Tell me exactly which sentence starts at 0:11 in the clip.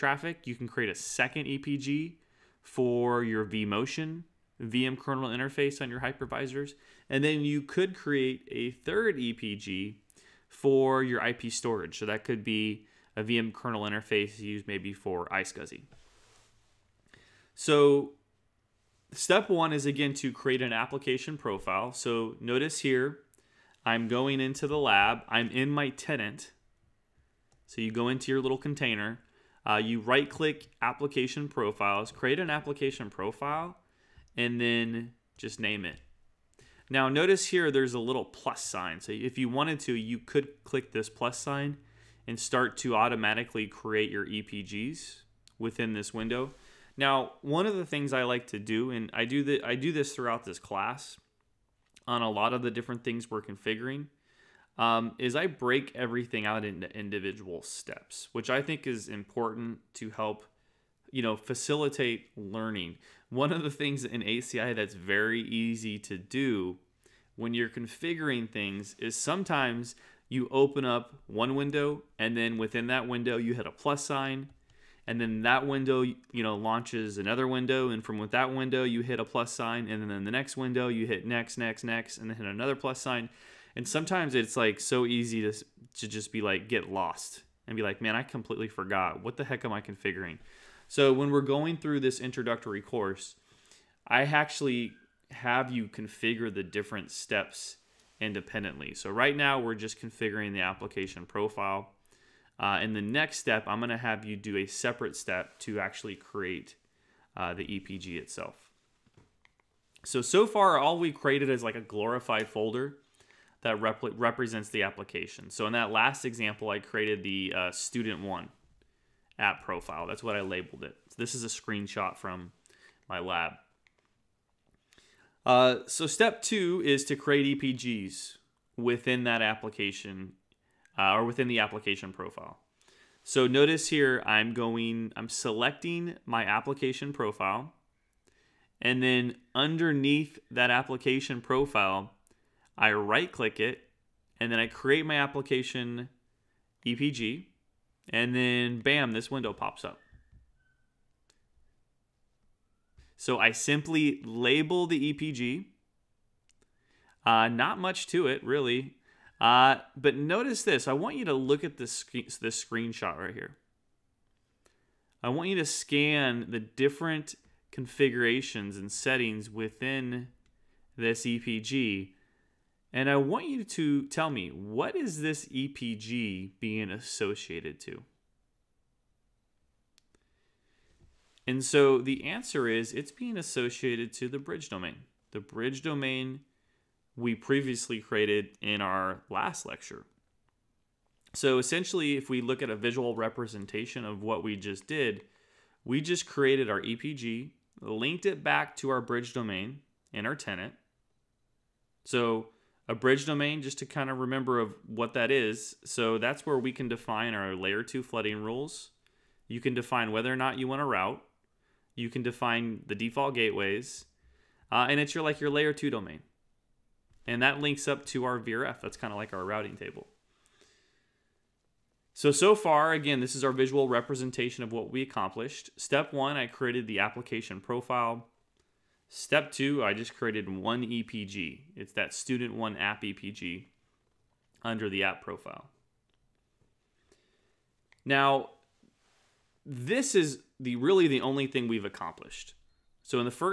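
So that could be a VM kernel interface used maybe for iSCSI.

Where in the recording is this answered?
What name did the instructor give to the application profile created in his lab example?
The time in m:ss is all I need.
1:57.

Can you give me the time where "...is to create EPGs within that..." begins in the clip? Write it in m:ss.
2:06.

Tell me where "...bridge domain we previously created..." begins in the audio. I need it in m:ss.
3:05.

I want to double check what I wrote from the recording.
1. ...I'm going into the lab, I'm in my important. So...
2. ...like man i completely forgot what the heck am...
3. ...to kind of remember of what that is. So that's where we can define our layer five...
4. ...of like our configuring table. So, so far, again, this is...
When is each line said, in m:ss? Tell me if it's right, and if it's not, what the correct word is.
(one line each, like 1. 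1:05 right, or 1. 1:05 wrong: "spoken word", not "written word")
1. 0:23 wrong: "tenant", not "important"
2. 1:27 right
3. 3:23 wrong: "two", not "five"
4. 3:39 wrong: "routing", not "configuring".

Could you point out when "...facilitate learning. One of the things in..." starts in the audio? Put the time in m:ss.
1:01.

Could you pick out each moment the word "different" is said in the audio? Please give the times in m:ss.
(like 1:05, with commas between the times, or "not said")
0:52, 1:36, 2:46.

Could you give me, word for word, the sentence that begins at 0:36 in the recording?
Now notice here there's a little plus sign.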